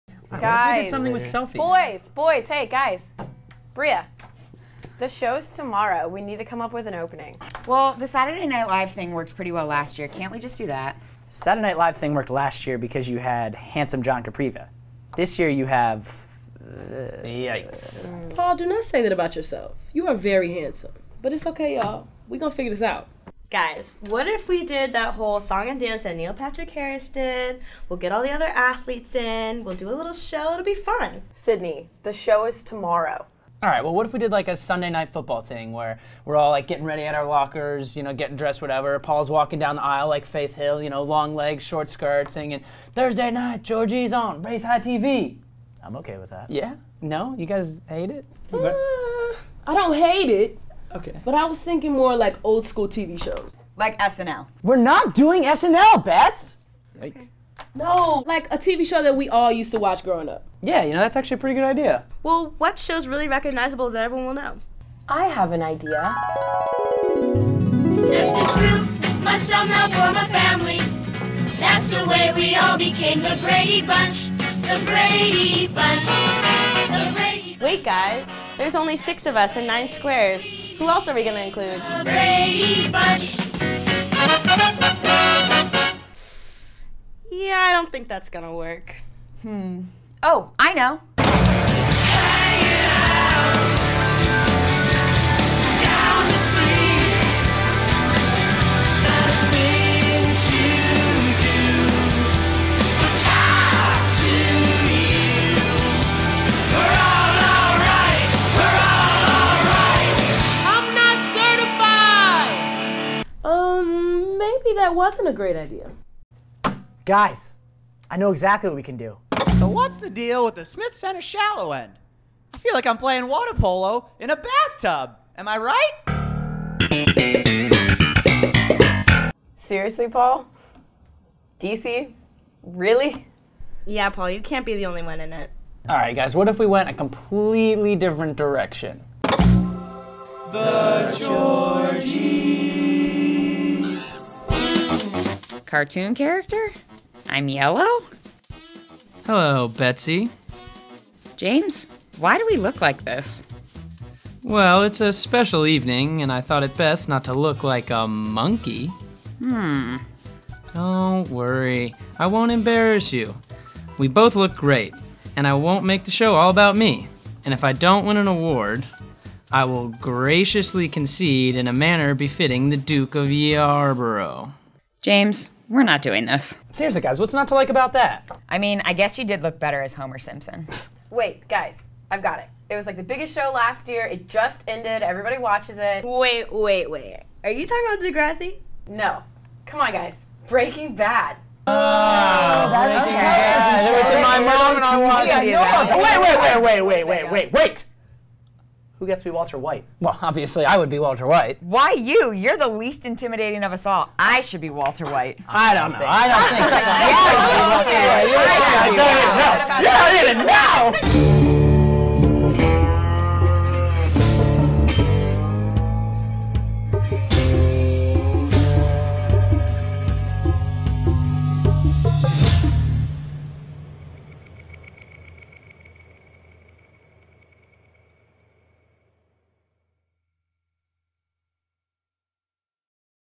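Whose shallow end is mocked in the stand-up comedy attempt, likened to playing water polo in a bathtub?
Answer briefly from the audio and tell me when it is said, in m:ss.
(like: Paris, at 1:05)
Smith Center, at 2:00.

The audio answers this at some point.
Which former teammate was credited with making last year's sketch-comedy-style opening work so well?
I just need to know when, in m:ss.
0:14.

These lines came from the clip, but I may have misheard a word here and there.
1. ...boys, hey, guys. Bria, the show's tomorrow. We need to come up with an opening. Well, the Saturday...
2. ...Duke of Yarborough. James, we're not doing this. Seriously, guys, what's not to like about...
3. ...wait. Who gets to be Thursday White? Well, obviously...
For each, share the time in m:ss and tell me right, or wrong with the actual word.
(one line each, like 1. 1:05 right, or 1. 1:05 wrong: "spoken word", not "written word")
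1. 0:02 right
2. 2:52 right
3. 3:17 wrong: "Walter", not "Thursday".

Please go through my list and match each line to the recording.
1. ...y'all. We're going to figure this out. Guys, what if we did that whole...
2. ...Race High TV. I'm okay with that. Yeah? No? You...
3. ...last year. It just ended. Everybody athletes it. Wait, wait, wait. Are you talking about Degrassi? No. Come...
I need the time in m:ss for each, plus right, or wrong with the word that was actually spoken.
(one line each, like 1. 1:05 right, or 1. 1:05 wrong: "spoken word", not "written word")
1. 0:21 right
2. 0:44 right
3. 3:03 wrong: "watches", not "athletes".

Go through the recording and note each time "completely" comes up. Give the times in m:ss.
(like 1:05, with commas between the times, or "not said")
2:16.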